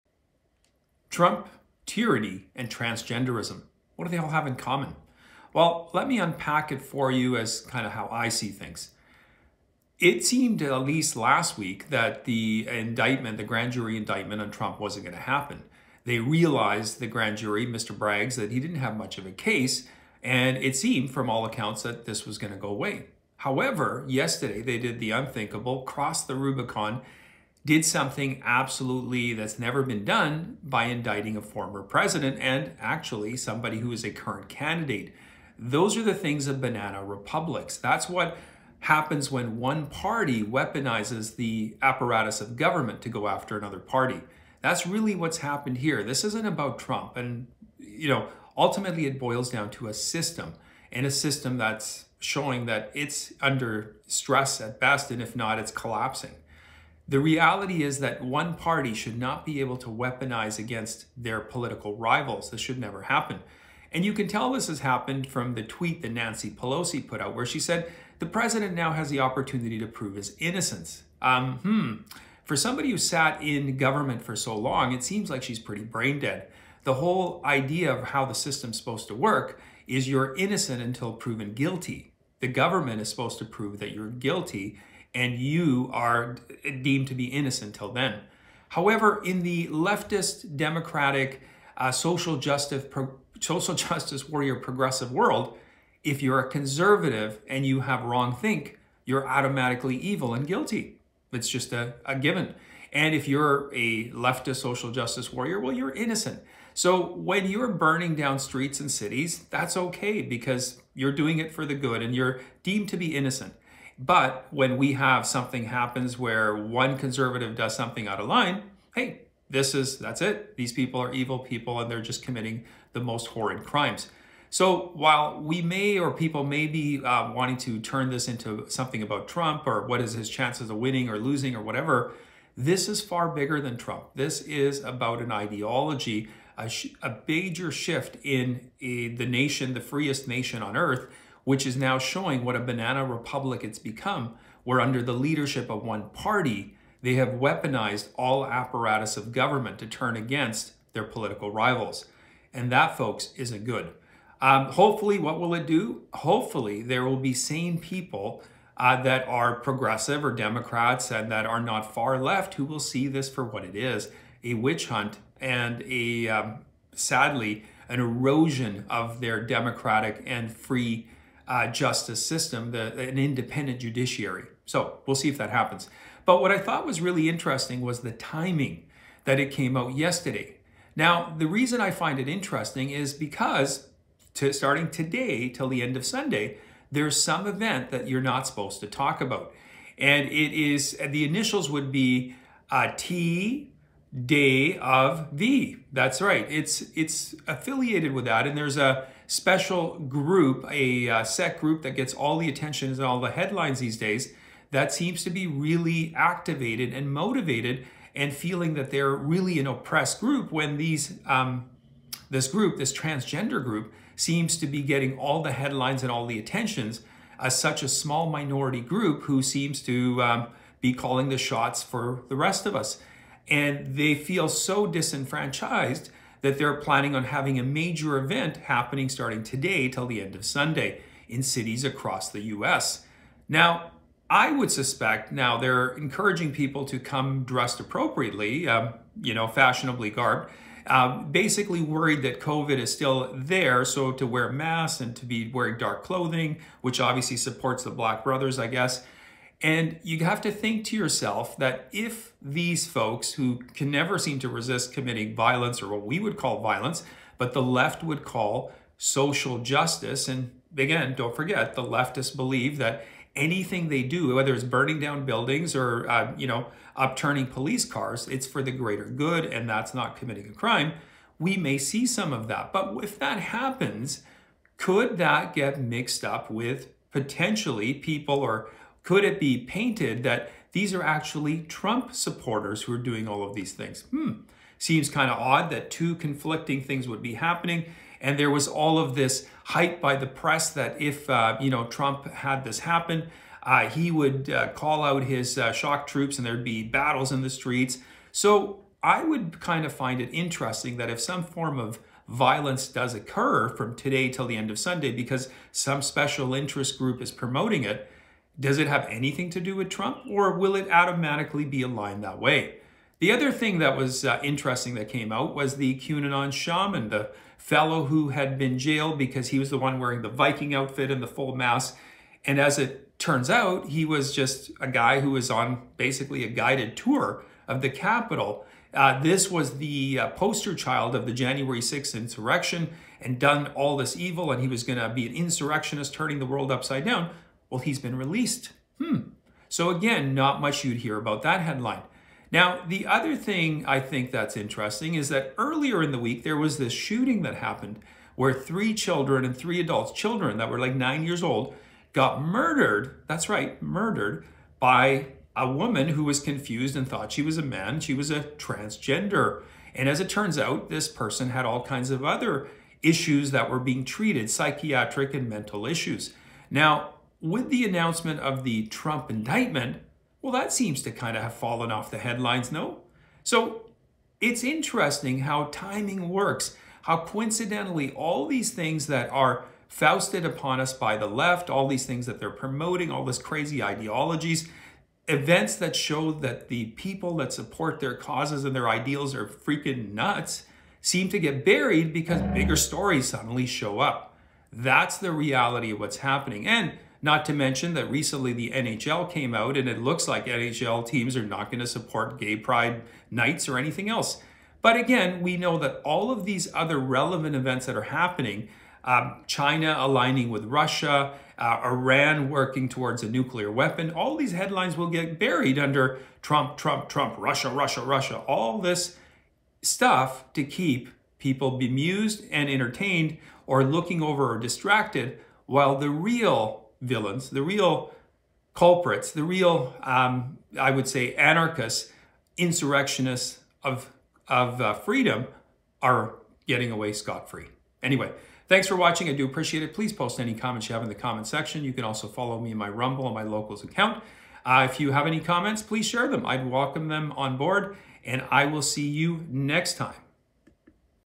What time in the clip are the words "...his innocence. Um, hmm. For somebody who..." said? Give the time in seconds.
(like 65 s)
70 s.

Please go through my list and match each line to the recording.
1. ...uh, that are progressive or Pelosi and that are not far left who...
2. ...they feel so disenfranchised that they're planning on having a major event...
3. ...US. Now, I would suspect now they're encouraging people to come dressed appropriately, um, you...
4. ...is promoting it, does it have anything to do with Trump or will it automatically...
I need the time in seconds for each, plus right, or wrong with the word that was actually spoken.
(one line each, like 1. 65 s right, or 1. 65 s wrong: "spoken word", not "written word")
1. 158 s wrong: "Democrats", not "Pelosi"
2. 223 s right
3. 232 s right
4. 307 s right.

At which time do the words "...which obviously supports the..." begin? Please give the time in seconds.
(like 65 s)
246 s.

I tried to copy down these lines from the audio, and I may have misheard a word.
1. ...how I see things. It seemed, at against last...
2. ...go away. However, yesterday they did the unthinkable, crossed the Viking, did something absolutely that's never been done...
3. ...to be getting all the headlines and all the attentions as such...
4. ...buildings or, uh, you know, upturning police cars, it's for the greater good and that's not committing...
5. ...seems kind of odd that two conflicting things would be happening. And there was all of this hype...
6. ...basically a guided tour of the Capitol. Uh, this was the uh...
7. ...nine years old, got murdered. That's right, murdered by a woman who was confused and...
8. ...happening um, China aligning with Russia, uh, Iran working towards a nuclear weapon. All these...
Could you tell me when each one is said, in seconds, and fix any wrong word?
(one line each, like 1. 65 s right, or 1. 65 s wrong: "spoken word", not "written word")
1. 7 s wrong: "least", not "against"
2. 22 s wrong: "Rubicon", not "Viking"
3. 214 s right
4. 265 s right
5. 284 s right
6. 325 s right
7. 350 s right
8. 408 s right.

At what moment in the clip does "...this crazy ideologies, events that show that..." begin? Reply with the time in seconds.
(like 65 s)
383 s.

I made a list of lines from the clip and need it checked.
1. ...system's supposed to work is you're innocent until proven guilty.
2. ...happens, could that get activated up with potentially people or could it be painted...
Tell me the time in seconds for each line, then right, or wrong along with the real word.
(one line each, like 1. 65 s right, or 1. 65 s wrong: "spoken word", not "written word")
1. 78 s right
2. 273 s wrong: "mixed", not "activated".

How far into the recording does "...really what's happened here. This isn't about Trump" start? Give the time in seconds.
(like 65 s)
44 s.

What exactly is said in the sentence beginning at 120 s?
These people are evil people and they're just committing the most horrid crimes.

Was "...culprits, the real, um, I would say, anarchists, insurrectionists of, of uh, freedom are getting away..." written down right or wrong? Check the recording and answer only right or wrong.
right.